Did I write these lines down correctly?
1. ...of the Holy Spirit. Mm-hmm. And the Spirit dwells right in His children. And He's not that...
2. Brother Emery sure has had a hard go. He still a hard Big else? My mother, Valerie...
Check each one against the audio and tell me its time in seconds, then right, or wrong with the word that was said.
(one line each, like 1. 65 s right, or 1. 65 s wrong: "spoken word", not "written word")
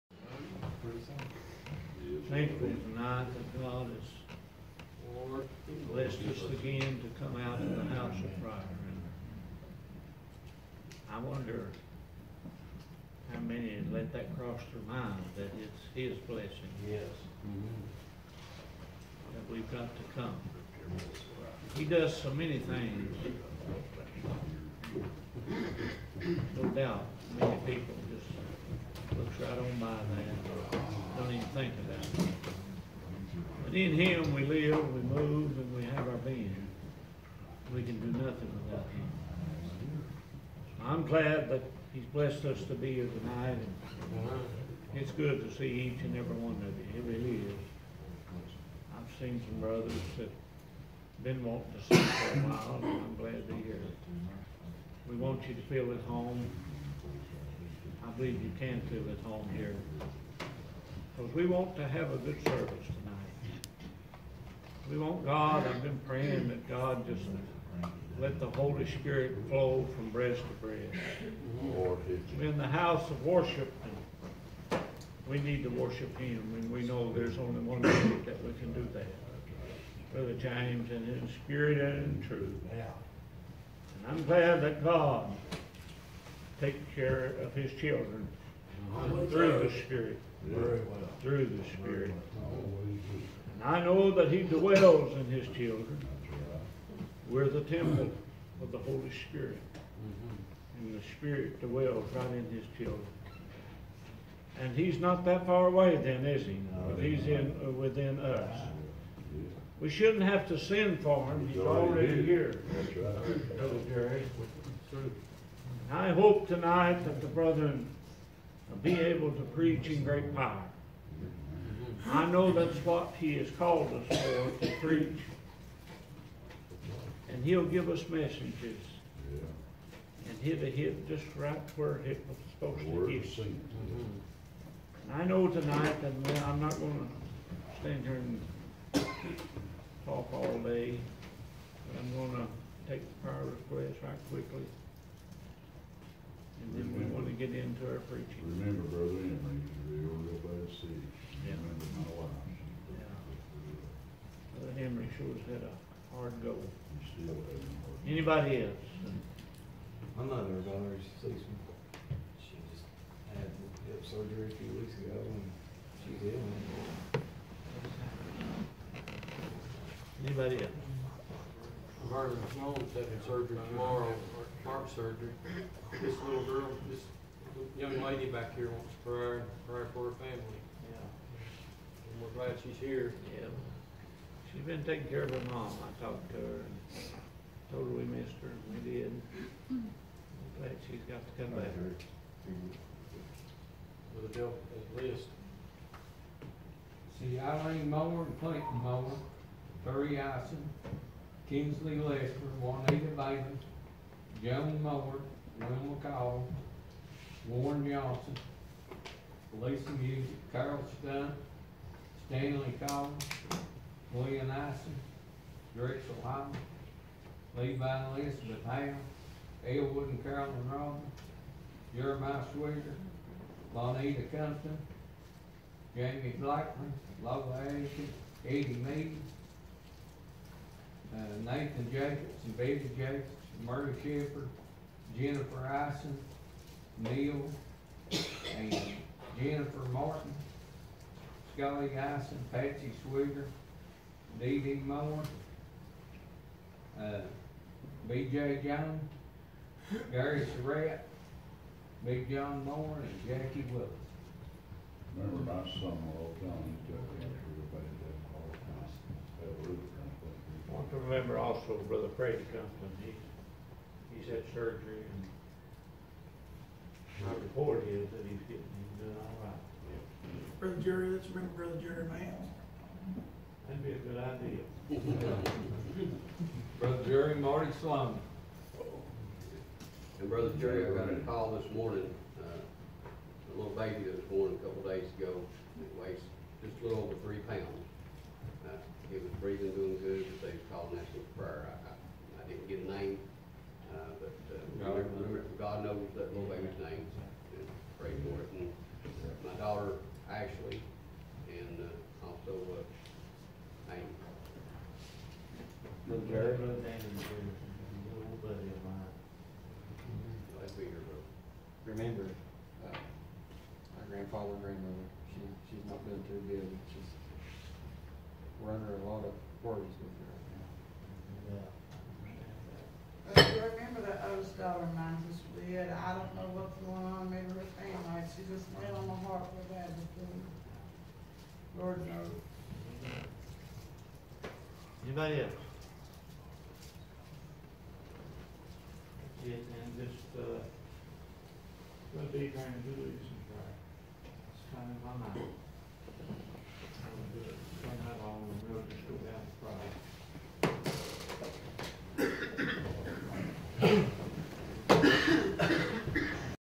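1. 98 s right
2. 154 s wrong: "Anybody", not "Big".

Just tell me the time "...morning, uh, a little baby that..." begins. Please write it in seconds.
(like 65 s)
281 s.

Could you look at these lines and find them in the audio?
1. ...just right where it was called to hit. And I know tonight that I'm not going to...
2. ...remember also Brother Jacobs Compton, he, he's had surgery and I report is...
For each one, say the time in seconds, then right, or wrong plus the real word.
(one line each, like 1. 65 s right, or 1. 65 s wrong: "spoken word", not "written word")
1. 131 s wrong: "supposed", not "called"
2. 260 s wrong: "Brady", not "Jacobs".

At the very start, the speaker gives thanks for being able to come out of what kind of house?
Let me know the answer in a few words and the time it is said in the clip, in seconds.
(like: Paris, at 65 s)
house of prayer, at 7 s.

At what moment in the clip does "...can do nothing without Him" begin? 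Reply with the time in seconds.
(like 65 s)
37 s.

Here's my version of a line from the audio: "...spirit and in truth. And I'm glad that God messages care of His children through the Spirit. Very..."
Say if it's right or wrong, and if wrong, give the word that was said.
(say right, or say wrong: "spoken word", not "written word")
wrong: "takes", not "messages".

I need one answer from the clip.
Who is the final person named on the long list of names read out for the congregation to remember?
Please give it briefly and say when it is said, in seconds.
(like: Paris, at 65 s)
Jackie Willis, at 253 s.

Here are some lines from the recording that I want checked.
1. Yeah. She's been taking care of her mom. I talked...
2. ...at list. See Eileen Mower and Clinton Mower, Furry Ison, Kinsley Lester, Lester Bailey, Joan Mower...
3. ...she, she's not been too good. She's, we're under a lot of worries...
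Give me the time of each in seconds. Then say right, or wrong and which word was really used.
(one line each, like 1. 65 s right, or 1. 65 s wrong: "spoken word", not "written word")
1. 183 s right
2. 194 s wrong: "Juanita", not "Lester"
3. 315 s right.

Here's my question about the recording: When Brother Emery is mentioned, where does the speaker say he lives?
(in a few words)
by the sea.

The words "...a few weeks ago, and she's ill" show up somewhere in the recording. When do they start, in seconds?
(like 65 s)
164 s.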